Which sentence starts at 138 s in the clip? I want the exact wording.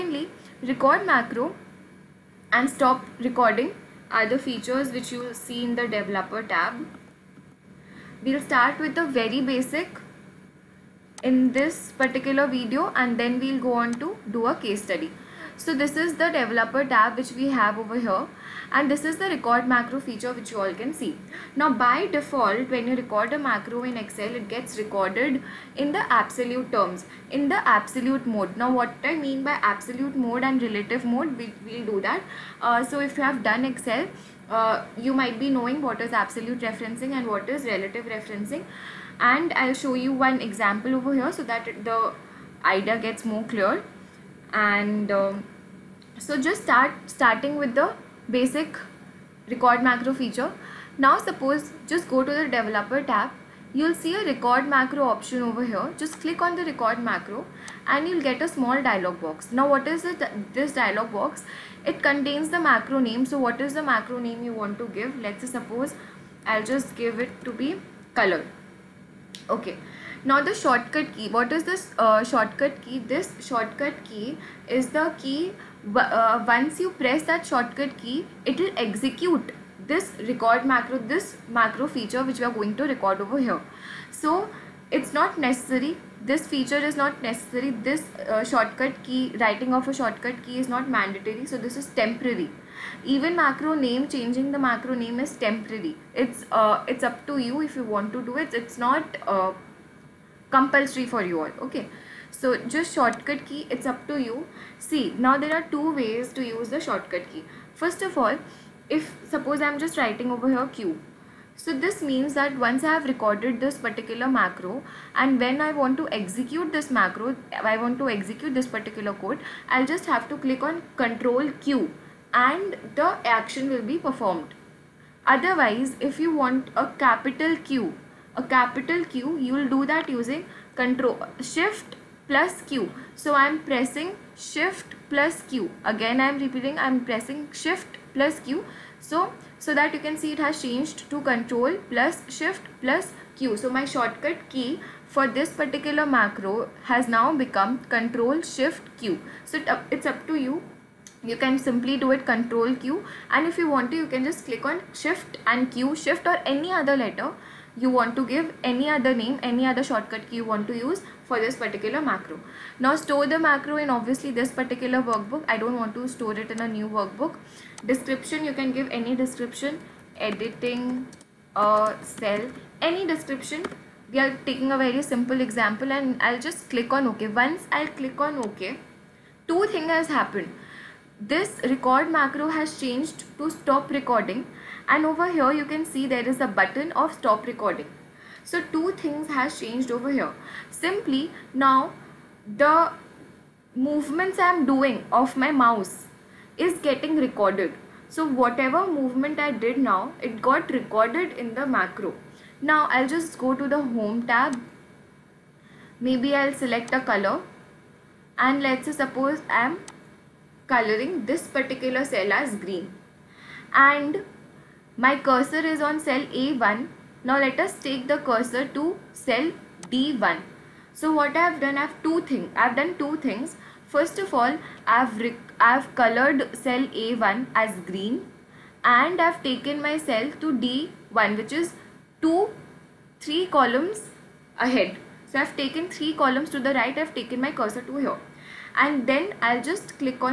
So, so that you can see it has changed to control plus shift plus Q.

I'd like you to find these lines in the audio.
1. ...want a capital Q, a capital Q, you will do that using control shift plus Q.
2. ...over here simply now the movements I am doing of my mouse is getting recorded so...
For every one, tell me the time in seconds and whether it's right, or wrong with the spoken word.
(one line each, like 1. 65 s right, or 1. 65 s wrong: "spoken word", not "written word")
1. 126 s right
2. 189 s right.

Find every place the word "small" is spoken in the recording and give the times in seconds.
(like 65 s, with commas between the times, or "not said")
58 s.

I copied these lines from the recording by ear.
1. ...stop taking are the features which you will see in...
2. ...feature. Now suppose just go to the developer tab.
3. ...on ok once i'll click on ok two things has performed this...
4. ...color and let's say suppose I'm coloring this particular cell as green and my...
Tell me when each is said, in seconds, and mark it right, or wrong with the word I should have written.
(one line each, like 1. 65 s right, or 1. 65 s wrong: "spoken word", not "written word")
1. 2 s wrong: "recording", not "taking"
2. 50 s right
3. 176 s wrong: "happened", not "performed"
4. 206 s right.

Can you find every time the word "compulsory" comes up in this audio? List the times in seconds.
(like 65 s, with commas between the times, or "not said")
100 s.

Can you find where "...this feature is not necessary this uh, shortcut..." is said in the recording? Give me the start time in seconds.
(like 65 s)
86 s.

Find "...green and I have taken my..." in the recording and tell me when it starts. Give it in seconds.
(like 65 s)
227 s.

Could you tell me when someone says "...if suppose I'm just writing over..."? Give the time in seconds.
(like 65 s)
108 s.